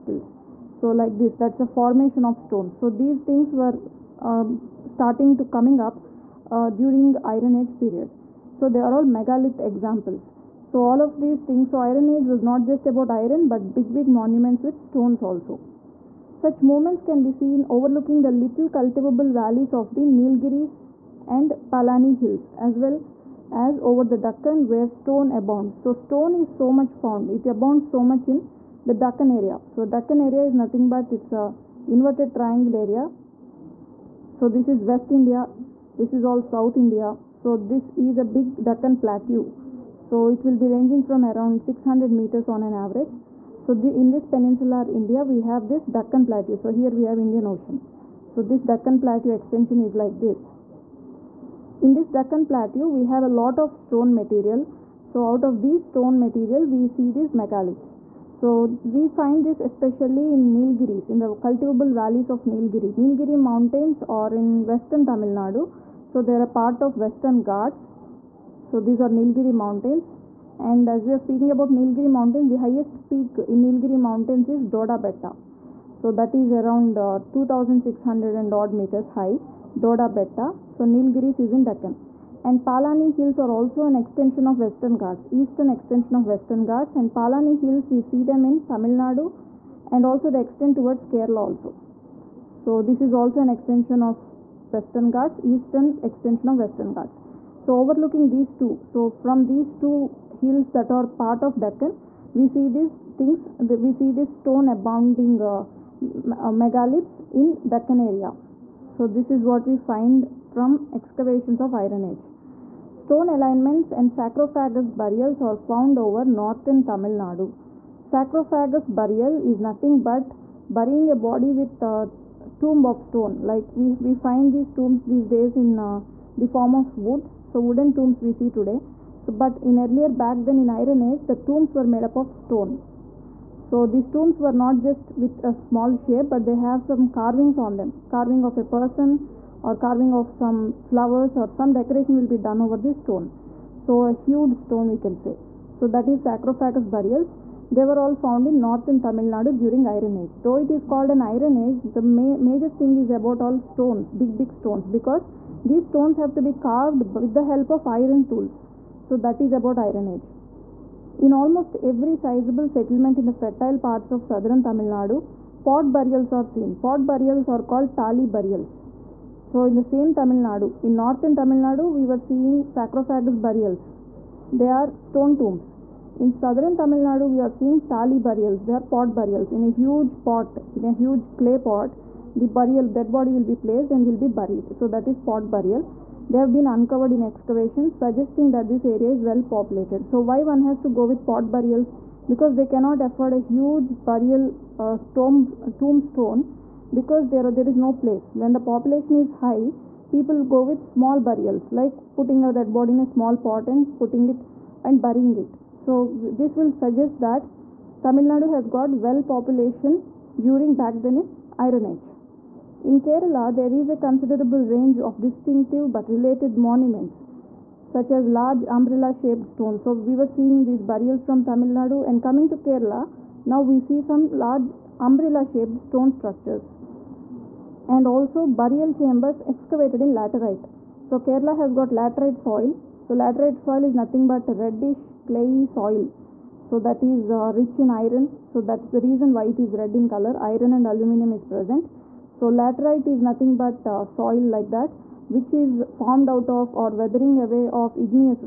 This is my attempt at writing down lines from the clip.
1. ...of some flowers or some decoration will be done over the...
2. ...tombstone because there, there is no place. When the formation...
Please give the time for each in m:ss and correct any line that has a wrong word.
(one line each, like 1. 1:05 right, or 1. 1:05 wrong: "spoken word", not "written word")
1. 2:20 right
2. 3:15 wrong: "population", not "formation".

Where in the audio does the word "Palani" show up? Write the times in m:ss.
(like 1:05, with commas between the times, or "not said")
0:21, 1:22, 1:27.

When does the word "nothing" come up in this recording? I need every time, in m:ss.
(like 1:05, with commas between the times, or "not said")
0:30, 1:59, 3:53, 4:03.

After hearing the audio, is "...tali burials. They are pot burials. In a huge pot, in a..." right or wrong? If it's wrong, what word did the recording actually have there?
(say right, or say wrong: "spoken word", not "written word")
right.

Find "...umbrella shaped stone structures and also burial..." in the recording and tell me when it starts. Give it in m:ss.
3:45.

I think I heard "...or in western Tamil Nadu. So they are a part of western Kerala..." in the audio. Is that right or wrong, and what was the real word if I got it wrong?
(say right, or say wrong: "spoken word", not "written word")
wrong: "Ghats", not "Kerala".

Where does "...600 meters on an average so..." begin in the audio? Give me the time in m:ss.
0:41.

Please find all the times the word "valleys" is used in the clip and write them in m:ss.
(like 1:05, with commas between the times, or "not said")
0:19, 1:01.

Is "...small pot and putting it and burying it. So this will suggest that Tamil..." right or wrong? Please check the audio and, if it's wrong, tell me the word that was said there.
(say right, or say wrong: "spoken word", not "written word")
right.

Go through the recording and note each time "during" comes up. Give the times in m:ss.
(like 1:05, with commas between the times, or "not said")
0:06, 2:29, 3:30.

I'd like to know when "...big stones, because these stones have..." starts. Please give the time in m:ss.
2:34.